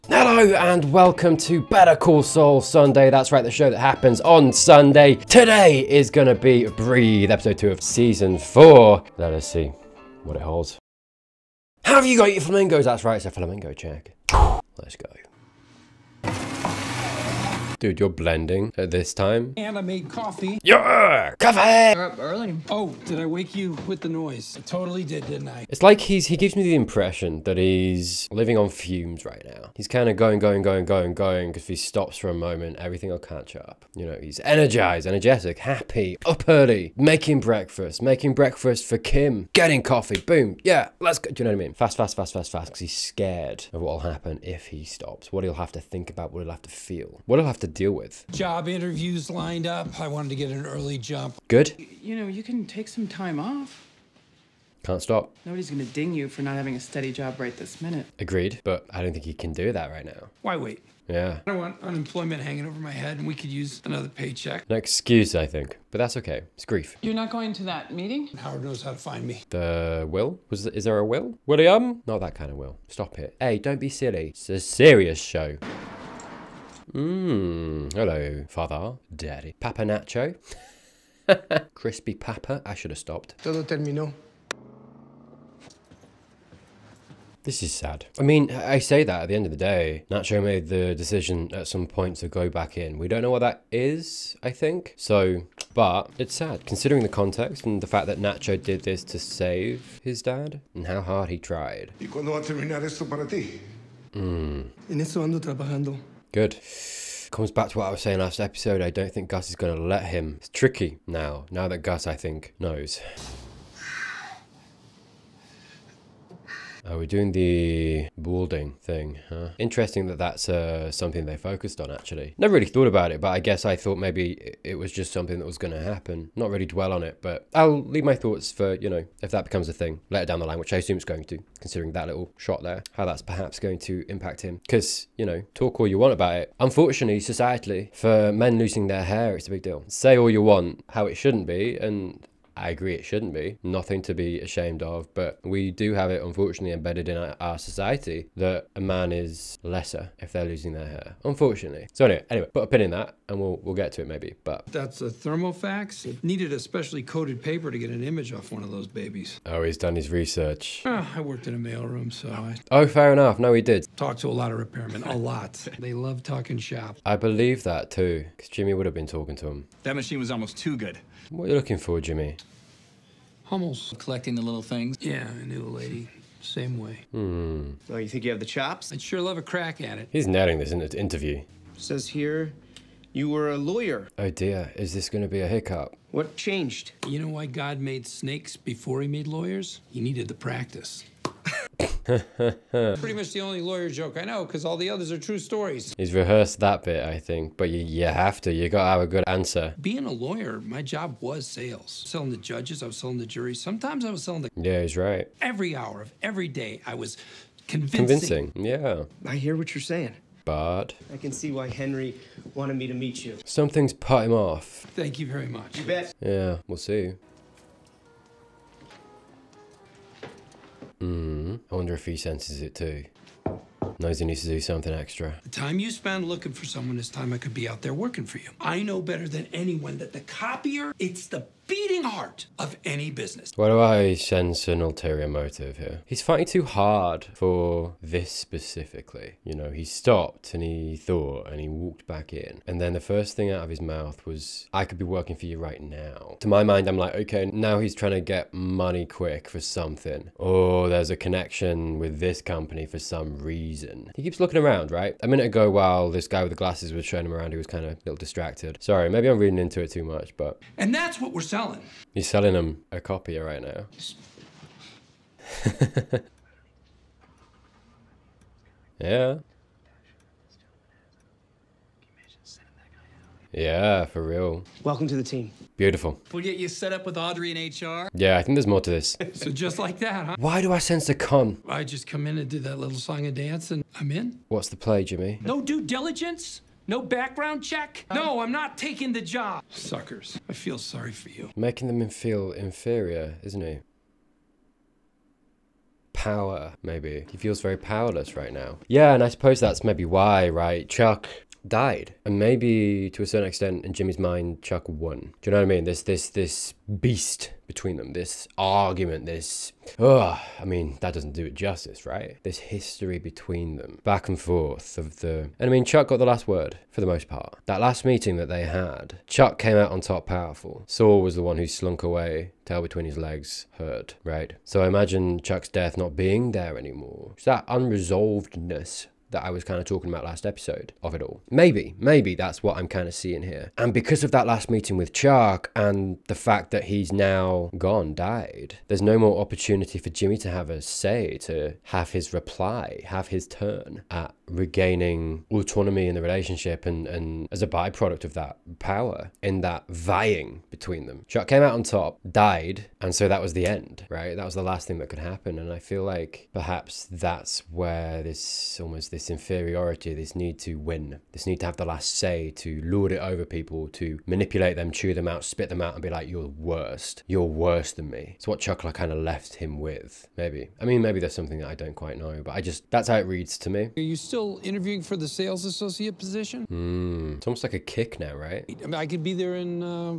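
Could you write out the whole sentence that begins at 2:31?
So anyway, anyway, put a pin in that and we'll, we'll get to it maybe, but.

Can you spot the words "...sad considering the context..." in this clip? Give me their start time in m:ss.
1:36.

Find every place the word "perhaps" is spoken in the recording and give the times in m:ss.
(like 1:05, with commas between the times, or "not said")
2:13, 5:56.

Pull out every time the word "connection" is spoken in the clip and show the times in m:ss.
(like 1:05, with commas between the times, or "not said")
4:11.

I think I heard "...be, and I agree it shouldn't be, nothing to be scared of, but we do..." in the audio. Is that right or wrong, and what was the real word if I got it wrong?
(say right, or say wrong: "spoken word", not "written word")
wrong: "ashamed", not "scared".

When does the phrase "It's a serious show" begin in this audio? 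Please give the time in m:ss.
1:14.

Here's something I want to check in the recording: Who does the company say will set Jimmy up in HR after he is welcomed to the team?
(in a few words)
Audrey.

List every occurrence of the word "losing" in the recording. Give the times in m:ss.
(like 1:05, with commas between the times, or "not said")
2:18, 2:30.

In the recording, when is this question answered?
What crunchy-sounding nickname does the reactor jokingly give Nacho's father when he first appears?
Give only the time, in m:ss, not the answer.
1:21.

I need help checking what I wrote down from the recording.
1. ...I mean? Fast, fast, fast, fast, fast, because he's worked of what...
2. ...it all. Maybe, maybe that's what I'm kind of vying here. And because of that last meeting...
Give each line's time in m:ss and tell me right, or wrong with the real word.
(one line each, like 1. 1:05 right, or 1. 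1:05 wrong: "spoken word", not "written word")
1. 0:41 wrong: "scared", not "worked"
2. 5:31 wrong: "seeing", not "vying".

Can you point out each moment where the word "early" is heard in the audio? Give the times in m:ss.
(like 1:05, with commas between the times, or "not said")
0:22, 0:36, 0:50.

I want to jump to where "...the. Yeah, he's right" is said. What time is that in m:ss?
3:24.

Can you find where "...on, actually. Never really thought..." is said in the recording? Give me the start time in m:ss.
2:01.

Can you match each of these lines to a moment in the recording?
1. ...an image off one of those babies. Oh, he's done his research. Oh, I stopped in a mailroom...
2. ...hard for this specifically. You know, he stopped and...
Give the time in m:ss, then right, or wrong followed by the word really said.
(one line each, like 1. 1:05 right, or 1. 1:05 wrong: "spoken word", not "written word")
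1. 2:37 wrong: "worked", not "stopped"
2. 3:56 right.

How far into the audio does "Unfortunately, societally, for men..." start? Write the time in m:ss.
2:16.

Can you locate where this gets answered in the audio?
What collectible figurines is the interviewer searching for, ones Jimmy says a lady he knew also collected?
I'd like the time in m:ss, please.
2:53.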